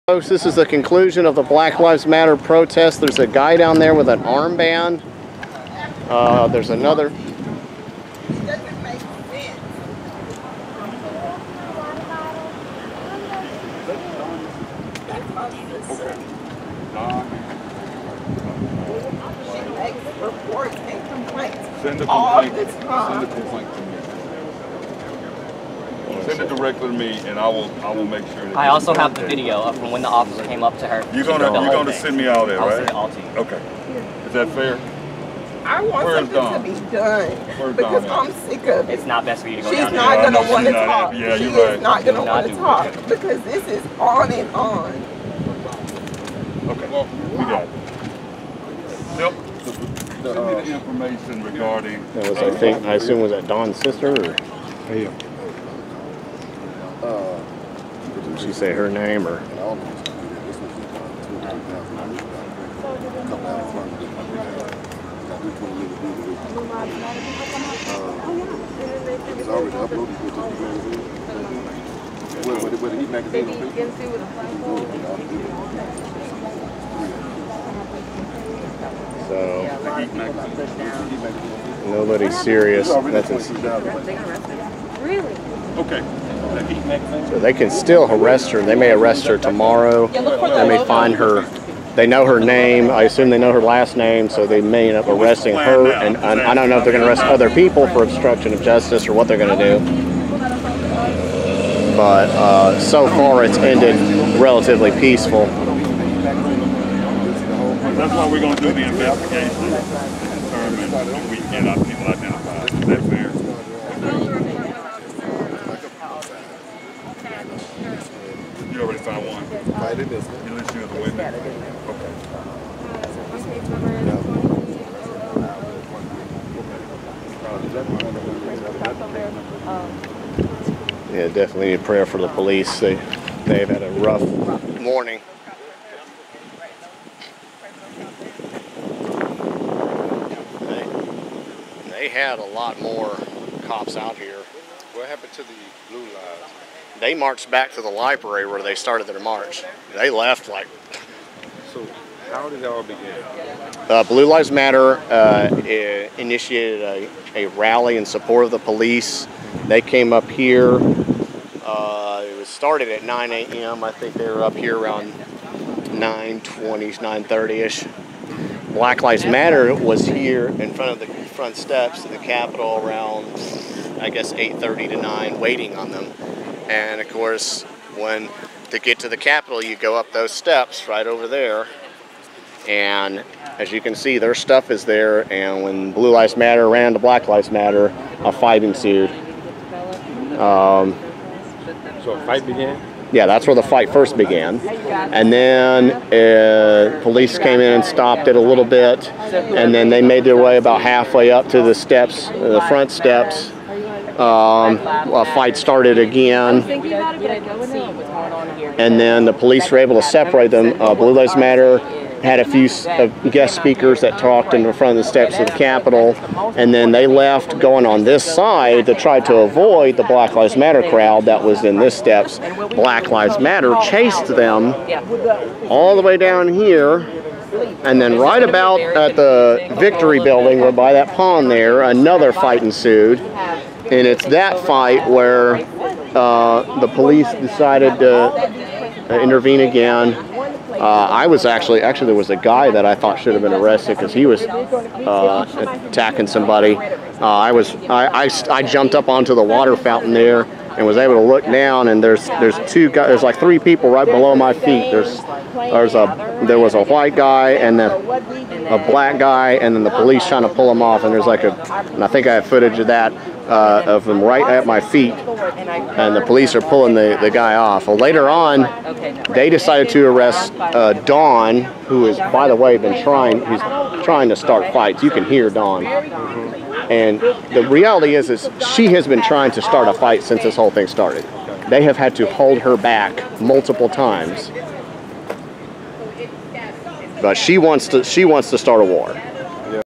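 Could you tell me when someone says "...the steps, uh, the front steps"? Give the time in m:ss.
3:21.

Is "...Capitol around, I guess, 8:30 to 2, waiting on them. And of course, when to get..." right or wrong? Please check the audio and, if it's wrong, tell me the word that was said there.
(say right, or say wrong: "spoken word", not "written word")
wrong: "9", not "2".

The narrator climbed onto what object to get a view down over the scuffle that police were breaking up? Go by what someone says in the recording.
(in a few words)
the water fountain.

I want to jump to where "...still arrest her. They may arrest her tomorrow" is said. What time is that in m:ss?
1:27.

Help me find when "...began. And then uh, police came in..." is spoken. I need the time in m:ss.
3:14.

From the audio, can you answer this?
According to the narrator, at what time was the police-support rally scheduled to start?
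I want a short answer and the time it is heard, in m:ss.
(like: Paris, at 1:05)
9 a.m., at 2:43.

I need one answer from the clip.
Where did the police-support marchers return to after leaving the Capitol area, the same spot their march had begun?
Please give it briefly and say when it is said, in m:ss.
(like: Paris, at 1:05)
the library, at 2:27.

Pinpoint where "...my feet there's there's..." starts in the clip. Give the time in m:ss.
4:14.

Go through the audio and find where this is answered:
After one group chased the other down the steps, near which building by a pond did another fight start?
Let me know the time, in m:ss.
3:49.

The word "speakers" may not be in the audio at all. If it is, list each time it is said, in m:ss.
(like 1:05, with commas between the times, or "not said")
3:33.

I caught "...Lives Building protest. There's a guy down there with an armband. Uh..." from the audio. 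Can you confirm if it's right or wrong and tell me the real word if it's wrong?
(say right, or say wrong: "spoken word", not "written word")
wrong: "Matter", not "Building".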